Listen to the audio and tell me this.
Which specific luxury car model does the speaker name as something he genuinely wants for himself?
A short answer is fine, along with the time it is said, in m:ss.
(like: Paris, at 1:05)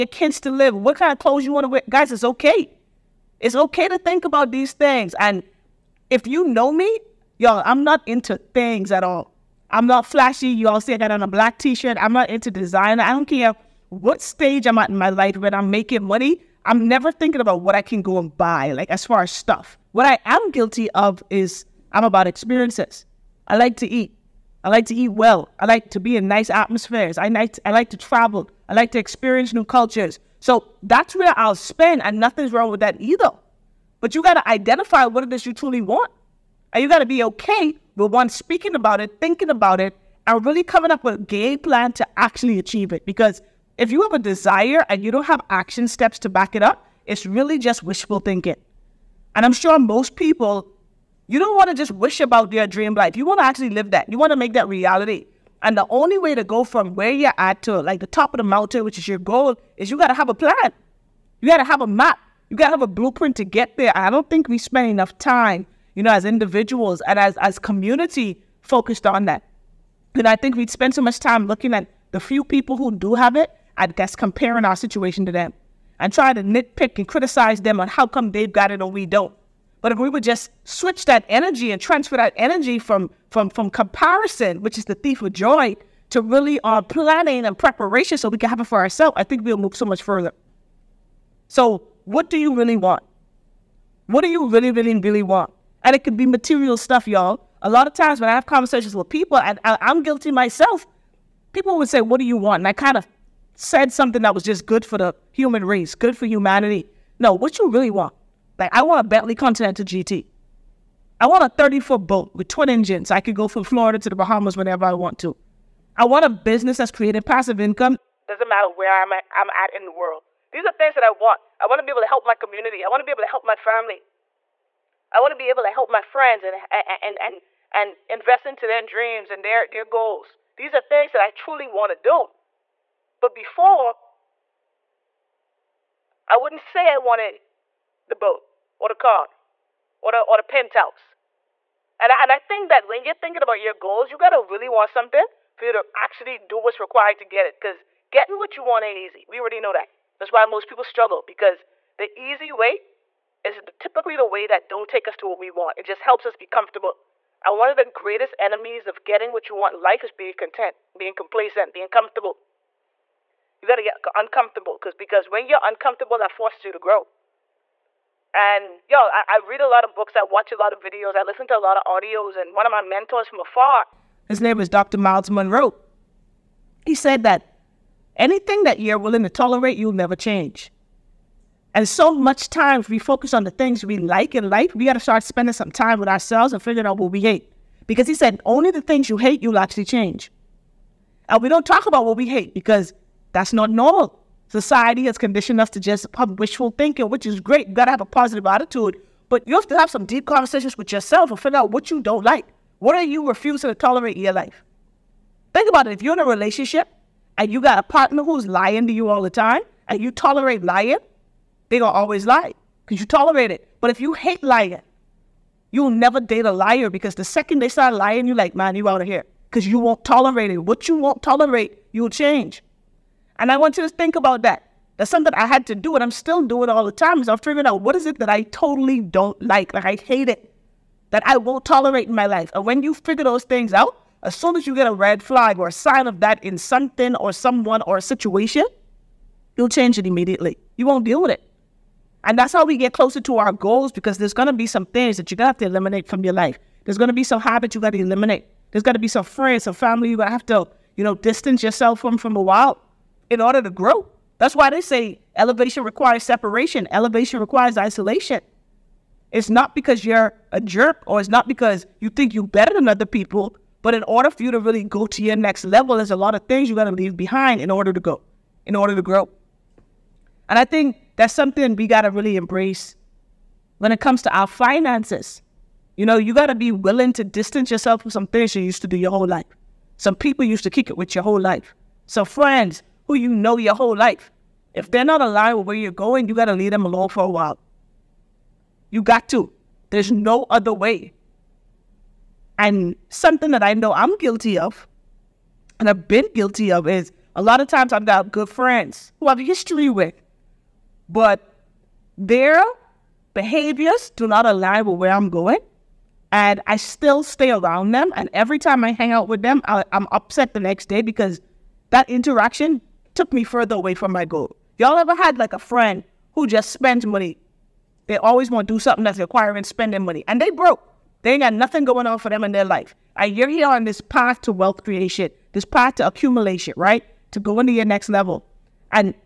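Bentley Continental GT, at 1:49.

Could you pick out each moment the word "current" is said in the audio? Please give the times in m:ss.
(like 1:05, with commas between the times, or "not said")
not said.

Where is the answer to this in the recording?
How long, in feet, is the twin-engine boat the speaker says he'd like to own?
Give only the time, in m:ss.
1:51.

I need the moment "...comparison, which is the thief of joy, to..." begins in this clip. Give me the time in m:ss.
1:23.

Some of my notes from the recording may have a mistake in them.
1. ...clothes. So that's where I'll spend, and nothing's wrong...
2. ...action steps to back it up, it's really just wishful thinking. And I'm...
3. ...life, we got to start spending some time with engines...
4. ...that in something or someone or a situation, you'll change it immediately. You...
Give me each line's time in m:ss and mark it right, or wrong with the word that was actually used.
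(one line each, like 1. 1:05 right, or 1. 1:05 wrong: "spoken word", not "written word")
1. 0:29 wrong: "cultures", not "clothes"
2. 0:45 right
3. 3:04 wrong: "ourselves", not "engines"
4. 3:56 right.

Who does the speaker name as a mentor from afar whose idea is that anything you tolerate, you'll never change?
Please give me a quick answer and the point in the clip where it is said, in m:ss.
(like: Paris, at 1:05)
Dr. Myles Munroe, at 2:54.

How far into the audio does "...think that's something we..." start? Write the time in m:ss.
4:30.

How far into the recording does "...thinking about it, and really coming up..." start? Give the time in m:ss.
0:39.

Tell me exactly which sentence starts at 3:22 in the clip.
What are you refusing to tolerate in your life?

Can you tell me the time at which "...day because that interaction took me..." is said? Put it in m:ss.
5:10.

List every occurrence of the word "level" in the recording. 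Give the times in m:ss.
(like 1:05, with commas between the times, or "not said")
4:25, 5:28.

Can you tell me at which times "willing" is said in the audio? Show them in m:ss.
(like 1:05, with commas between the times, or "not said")
2:58, 4:36.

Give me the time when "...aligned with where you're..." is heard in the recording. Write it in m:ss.
4:45.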